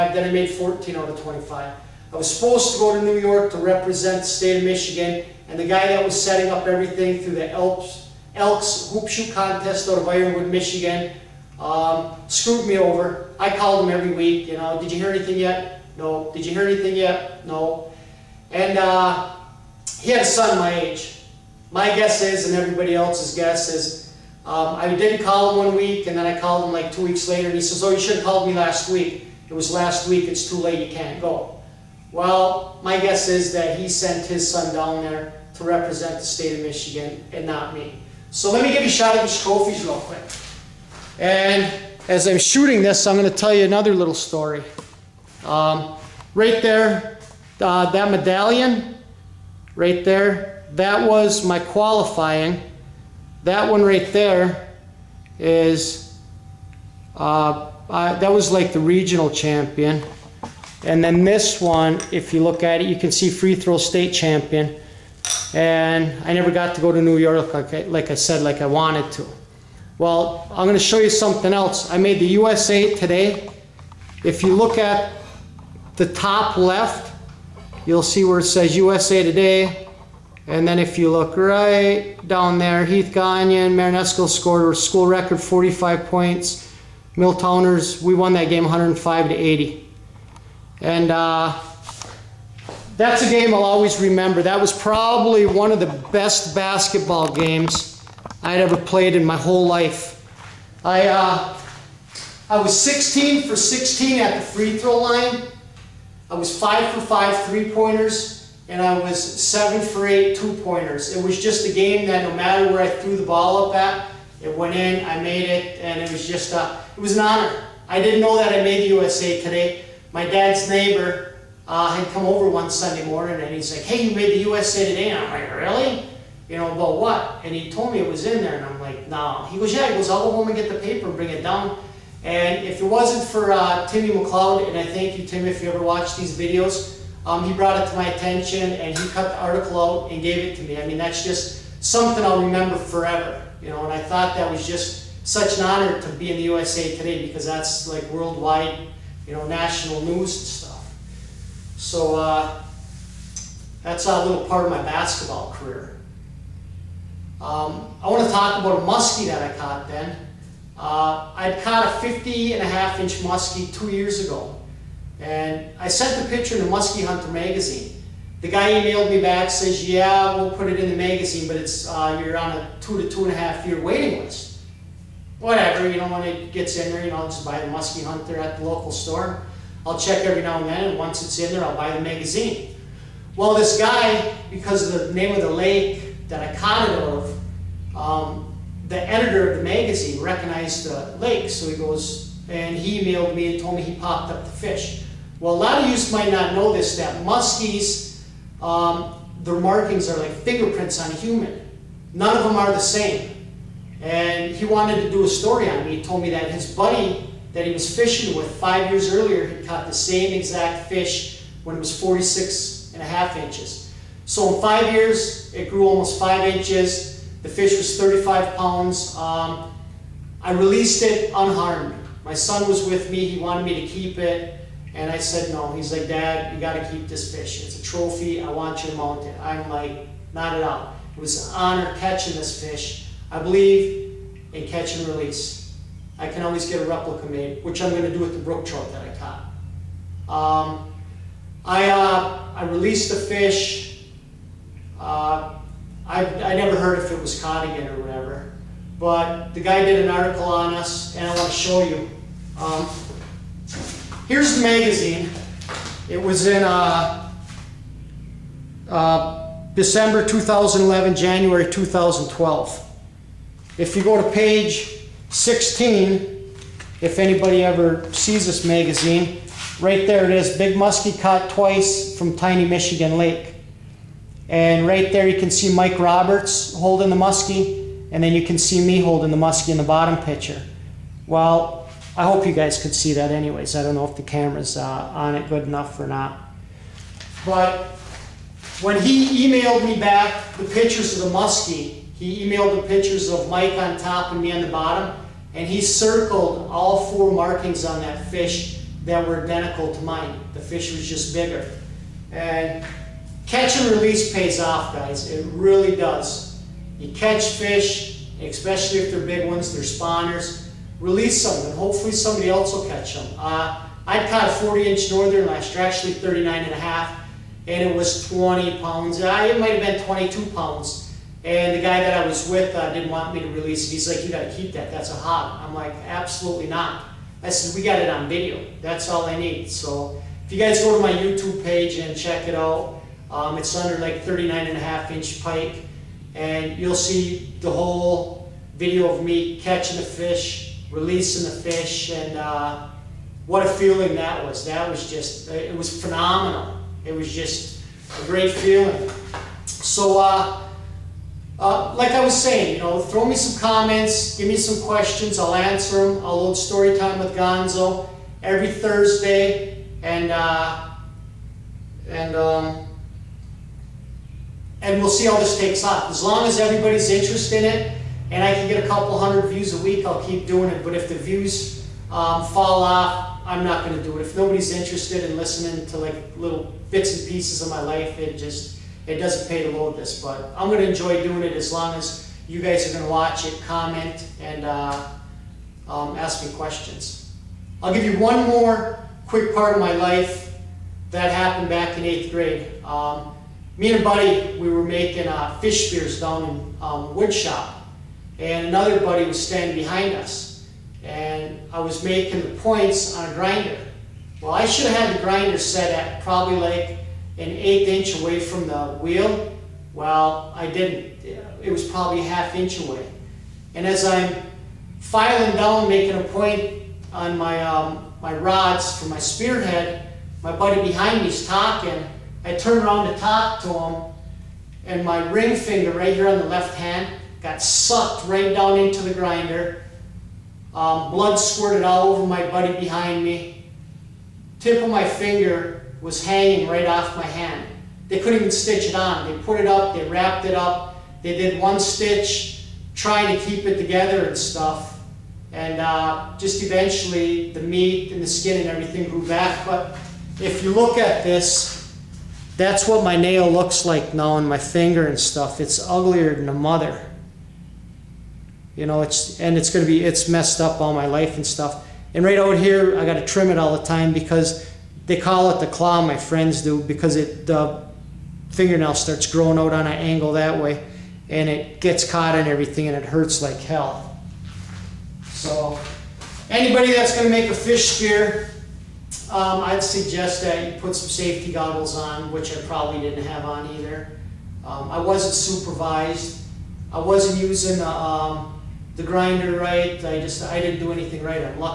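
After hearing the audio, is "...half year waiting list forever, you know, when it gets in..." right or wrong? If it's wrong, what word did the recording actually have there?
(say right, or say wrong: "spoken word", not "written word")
wrong: "whatever", not "forever".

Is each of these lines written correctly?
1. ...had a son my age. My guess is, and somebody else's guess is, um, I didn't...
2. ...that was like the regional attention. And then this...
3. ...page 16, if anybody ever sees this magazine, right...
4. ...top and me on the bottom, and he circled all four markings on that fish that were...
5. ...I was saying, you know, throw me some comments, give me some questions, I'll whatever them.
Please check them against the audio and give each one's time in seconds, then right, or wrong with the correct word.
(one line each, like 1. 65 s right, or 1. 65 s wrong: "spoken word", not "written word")
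1. 20 s wrong: "everybody", not "somebody"
2. 58 s wrong: "champion", not "attention"
3. 264 s right
4. 293 s right
5. 352 s wrong: "answer", not "whatever".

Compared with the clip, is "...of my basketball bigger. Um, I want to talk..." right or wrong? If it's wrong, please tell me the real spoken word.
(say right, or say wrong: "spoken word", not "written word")
wrong: "career", not "bigger".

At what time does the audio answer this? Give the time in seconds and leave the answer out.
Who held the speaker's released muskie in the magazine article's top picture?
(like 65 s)
275 s.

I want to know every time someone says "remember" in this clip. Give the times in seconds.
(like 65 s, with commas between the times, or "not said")
94 s, 142 s.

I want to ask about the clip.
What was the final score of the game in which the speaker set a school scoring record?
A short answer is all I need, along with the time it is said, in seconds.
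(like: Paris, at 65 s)
105 to 80, at 88 s.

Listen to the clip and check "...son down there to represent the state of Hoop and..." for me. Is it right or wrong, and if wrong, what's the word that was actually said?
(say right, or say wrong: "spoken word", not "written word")
wrong: "Michigan", not "Hoop".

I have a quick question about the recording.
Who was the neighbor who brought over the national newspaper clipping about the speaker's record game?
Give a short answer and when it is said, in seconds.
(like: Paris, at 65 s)
Timmy McLeod, at 133 s.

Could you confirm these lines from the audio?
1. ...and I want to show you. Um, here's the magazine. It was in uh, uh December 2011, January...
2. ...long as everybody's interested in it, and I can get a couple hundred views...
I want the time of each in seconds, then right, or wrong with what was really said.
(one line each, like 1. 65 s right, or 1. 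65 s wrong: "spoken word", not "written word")
1. 251 s right
2. 366 s right.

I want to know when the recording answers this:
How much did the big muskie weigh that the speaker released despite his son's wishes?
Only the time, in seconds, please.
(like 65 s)
217 s.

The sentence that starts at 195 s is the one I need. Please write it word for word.
Well, a lot of you might not know this, that muskies, um, their markings are like fingerprints on a human.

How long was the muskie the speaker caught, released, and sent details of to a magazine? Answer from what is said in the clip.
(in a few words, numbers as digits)
50.5 inches.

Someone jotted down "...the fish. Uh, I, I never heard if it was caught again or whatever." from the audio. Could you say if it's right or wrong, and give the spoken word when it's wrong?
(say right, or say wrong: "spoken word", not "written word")
right.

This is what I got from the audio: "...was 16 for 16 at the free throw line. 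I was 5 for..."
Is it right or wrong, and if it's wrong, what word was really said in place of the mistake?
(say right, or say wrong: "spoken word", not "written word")
right.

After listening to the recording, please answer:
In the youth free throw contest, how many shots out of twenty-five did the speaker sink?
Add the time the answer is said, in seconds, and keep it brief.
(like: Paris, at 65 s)
14, at 0 s.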